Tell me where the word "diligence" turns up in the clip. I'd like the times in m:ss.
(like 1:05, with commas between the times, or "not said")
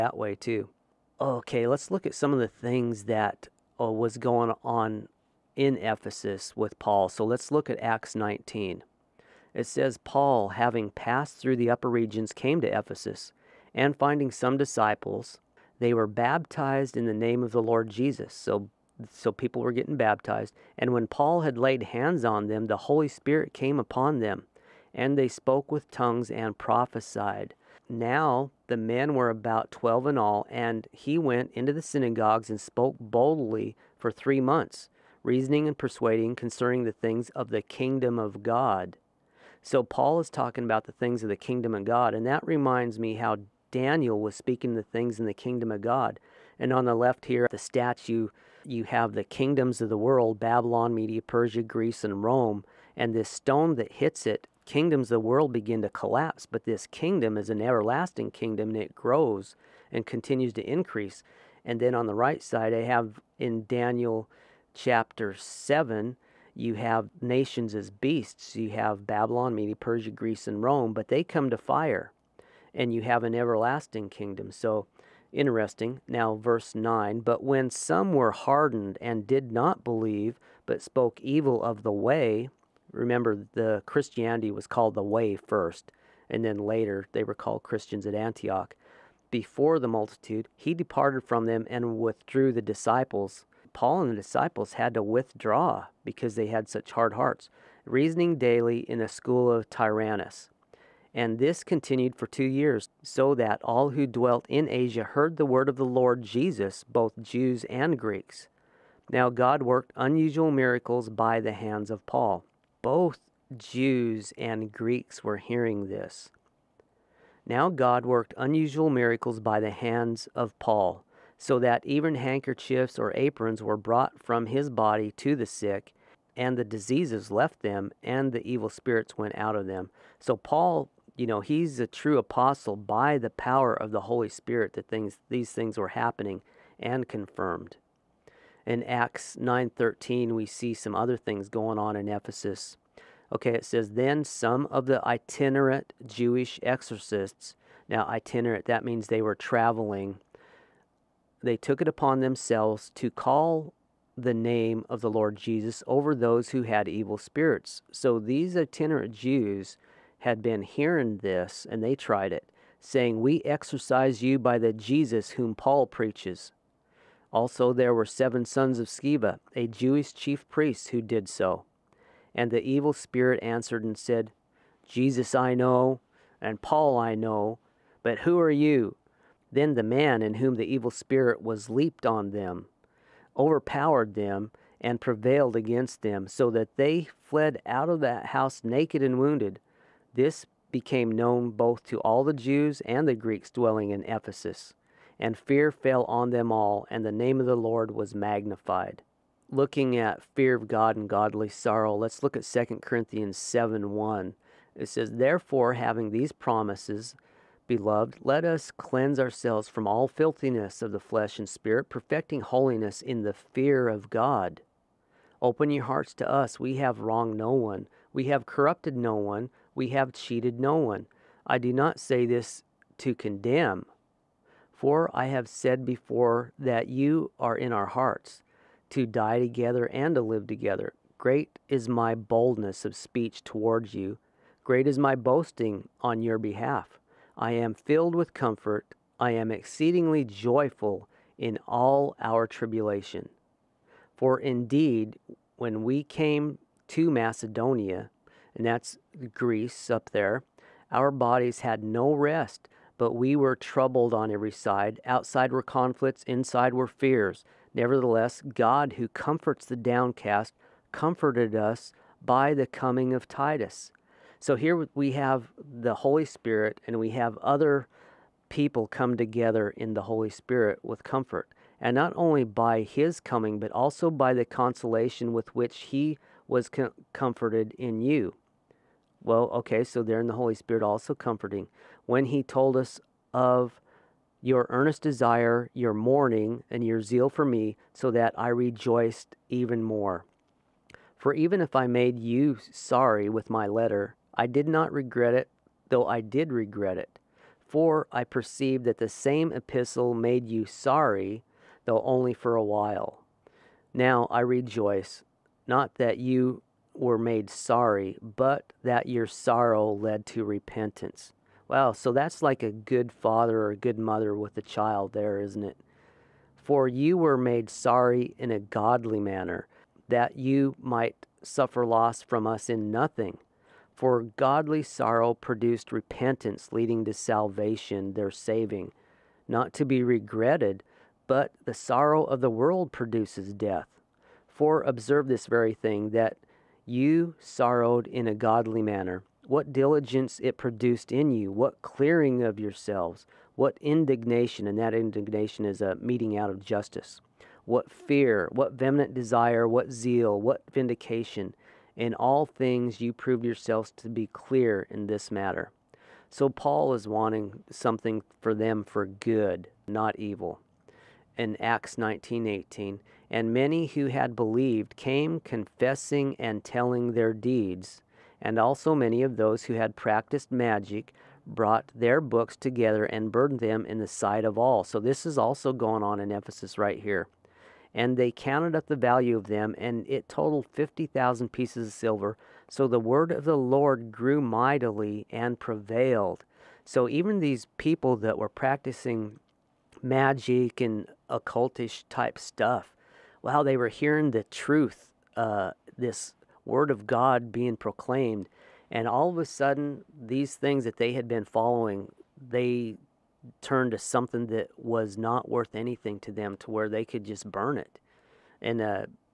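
5:39.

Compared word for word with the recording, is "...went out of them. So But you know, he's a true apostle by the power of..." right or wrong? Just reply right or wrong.
wrong.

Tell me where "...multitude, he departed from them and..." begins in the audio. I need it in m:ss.
1:29.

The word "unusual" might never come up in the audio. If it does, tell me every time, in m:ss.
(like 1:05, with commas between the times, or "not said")
1:49, 1:58.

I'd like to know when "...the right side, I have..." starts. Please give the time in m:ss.
1:02.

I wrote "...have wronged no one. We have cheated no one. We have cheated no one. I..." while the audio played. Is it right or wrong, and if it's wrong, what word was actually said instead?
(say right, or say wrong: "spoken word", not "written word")
wrong: "corrupted", not "cheated".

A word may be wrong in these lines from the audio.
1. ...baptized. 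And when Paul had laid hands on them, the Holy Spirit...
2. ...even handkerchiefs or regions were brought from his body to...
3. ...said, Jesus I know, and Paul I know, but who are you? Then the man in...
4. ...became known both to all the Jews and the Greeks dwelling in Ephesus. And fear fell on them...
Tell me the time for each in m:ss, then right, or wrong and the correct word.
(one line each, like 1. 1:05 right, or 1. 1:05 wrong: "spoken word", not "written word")
1. 0:19 right
2. 2:01 wrong: "aprons", not "regions"
3. 2:53 right
4. 3:10 right.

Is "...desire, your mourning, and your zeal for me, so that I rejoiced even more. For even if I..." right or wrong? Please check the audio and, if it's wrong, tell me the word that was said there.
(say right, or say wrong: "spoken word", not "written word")
right.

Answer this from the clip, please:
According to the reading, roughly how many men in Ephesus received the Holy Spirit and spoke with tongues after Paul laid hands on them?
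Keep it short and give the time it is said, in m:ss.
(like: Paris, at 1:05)
12, at 0:29.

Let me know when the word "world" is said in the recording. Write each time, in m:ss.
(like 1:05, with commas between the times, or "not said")
0:49, 0:55, 5:32.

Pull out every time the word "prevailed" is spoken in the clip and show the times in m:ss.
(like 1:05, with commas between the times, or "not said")
3:04, 6:25.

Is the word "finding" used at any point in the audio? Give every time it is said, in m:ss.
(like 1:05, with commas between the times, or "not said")
0:13.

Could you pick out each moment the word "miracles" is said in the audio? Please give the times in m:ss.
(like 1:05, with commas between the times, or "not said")
1:50, 1:58.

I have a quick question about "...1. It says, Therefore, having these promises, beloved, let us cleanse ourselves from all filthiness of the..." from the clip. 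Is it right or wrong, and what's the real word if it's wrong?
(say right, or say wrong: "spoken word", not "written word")
right.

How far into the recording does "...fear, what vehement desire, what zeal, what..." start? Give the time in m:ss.
5:47.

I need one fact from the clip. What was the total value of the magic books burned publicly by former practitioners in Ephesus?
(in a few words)
50,000 pieces of silver.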